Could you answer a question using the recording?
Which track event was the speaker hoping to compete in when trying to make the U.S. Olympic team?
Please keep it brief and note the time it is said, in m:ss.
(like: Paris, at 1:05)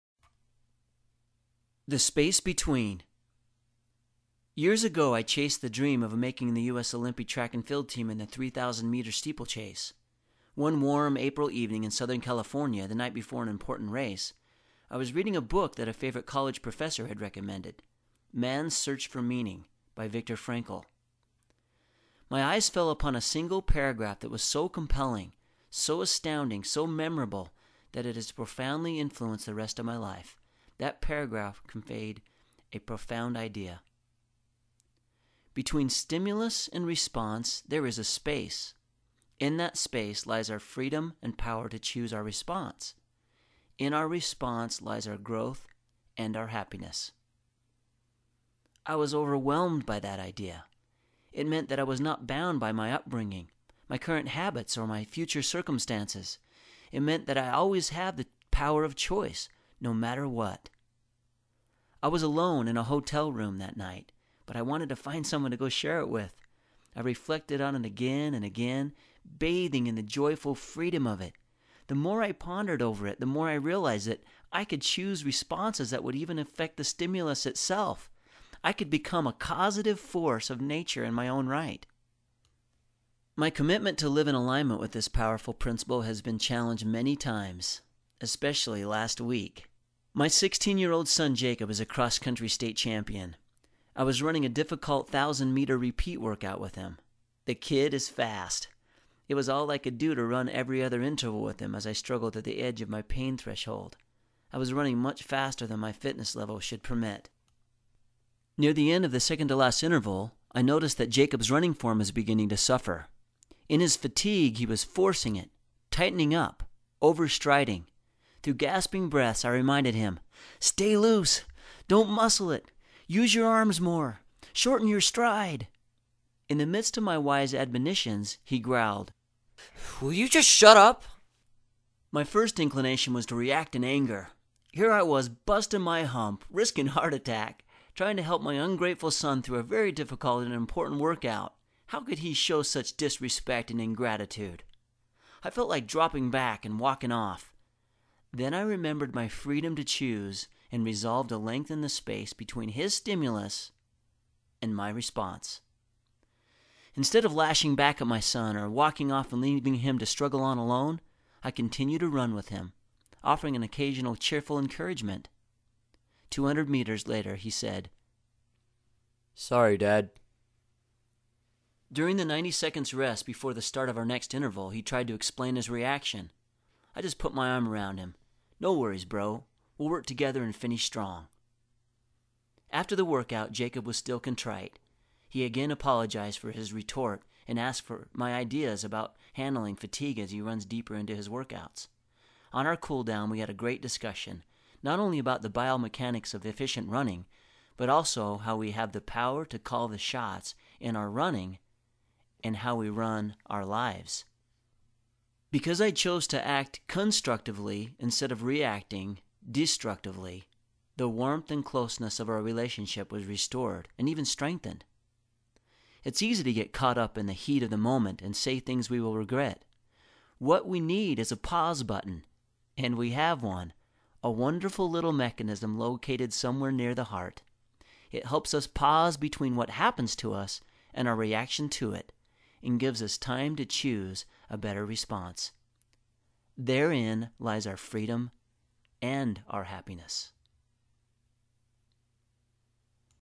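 3,000 meter steeplechase, at 0:08.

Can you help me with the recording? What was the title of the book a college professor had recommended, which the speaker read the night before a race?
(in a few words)
Man's Search for Meaning.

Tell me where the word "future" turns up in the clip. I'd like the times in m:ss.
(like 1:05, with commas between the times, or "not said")
0:55.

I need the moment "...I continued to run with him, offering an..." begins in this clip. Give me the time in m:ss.
2:41.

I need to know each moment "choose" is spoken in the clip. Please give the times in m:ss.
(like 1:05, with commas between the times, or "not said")
0:41, 1:14, 2:29, 3:53.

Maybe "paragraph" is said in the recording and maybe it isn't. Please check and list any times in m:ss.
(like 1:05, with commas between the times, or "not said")
0:23, 0:30.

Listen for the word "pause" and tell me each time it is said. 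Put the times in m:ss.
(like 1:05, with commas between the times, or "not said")
3:41, 3:48.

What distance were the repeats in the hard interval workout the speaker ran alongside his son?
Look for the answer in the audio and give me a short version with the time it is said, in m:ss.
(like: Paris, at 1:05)
1,000 meters, at 1:35.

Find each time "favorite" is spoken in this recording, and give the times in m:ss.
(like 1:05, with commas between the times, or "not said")
0:15.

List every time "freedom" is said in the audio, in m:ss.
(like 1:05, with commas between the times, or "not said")
0:40, 1:10, 2:29, 3:57.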